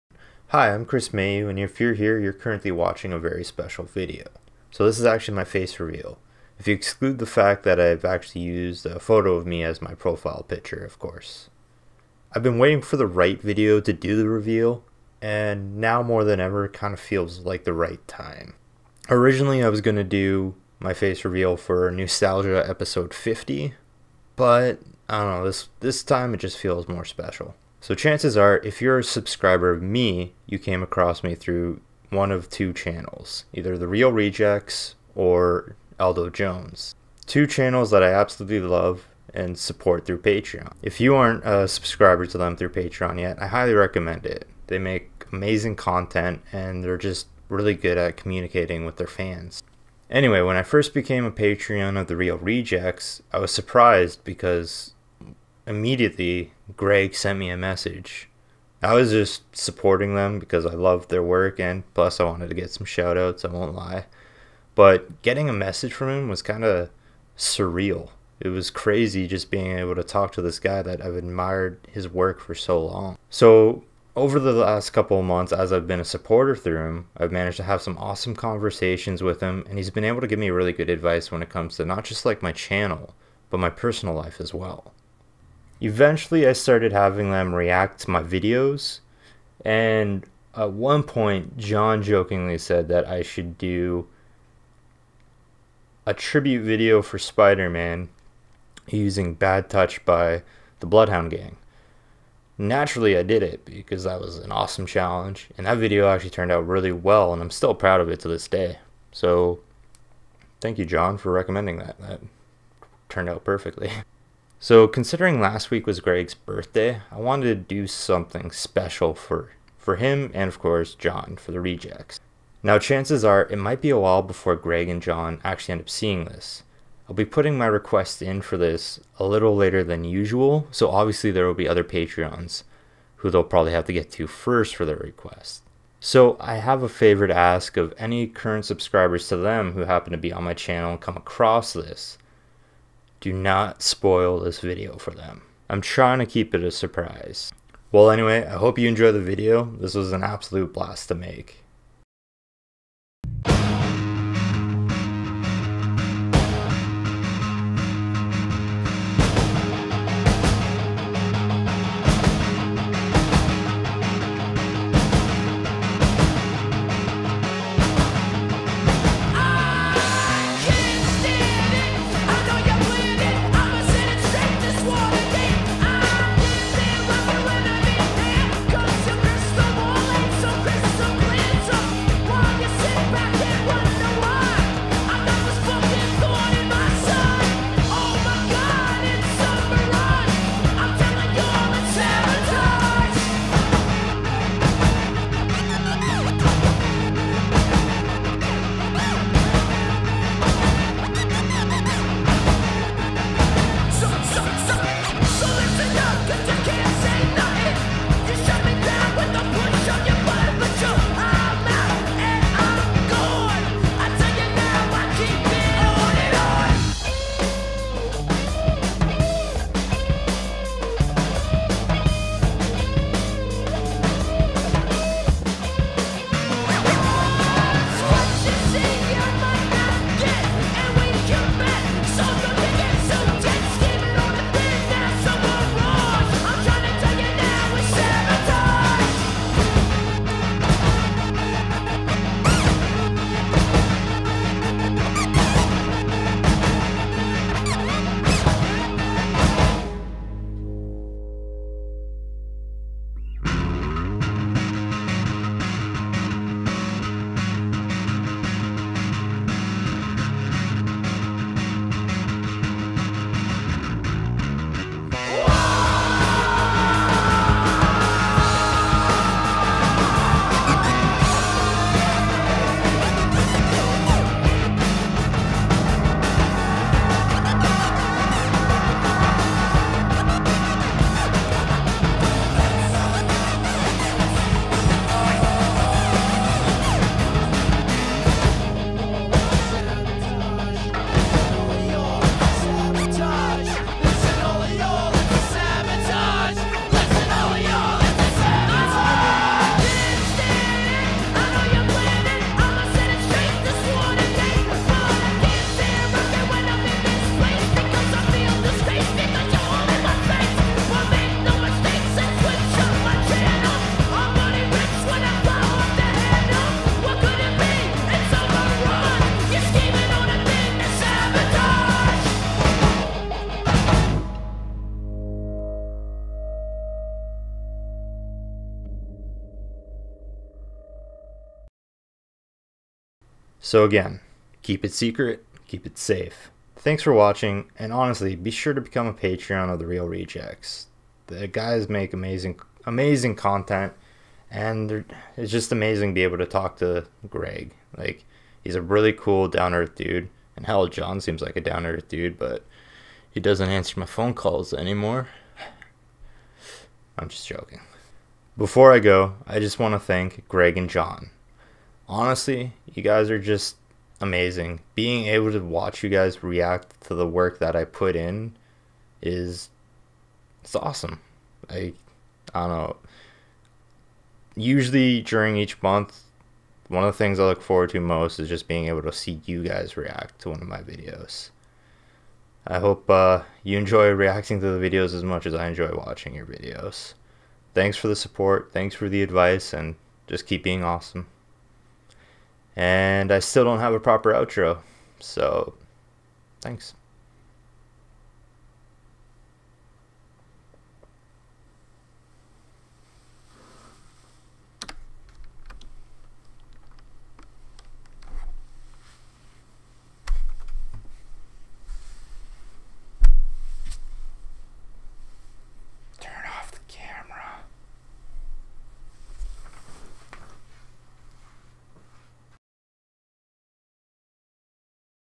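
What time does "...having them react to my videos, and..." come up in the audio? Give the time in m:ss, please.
1:26.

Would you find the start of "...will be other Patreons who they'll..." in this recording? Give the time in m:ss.
2:11.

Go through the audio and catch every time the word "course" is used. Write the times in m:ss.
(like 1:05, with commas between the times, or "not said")
0:10, 2:00.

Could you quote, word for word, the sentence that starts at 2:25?
I'm trying to keep it a surprise.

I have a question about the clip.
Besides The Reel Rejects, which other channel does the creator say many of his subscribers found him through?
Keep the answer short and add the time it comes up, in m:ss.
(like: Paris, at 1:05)
Aldo Jones, at 0:35.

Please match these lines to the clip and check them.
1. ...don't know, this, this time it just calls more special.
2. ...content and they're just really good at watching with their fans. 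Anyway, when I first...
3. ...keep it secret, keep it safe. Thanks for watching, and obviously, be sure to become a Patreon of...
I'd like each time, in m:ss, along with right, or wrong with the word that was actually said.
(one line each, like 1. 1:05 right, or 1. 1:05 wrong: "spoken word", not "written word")
1. 0:25 wrong: "feels", not "calls"
2. 0:45 wrong: "communicating", not "watching"
3. 5:34 wrong: "honestly", not "obviously".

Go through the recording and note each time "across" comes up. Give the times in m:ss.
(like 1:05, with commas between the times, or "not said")
0:30, 2:21.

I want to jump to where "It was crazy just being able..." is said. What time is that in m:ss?
1:08.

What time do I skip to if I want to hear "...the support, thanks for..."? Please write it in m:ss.
6:28.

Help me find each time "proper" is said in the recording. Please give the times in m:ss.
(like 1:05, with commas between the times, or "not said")
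6:33.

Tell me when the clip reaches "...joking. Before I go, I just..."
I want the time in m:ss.
5:57.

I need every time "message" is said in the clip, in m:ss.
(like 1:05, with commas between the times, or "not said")
0:57, 1:05.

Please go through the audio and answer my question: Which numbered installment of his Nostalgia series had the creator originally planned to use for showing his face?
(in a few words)
50.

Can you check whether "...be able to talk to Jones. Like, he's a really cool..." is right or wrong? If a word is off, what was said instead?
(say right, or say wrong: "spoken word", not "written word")
wrong: "Greg", not "Jones".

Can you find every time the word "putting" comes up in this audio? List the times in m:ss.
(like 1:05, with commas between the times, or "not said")
2:07.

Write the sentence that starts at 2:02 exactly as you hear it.
Now chances are it might be a while before Greg and John actually end up seeing this.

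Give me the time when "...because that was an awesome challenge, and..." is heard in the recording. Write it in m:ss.
1:43.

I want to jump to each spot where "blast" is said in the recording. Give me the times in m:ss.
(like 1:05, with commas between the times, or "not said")
2:30.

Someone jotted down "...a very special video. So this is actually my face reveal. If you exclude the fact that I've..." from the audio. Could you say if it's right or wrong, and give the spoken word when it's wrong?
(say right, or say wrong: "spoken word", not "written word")
right.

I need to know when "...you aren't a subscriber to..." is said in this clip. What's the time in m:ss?
0:41.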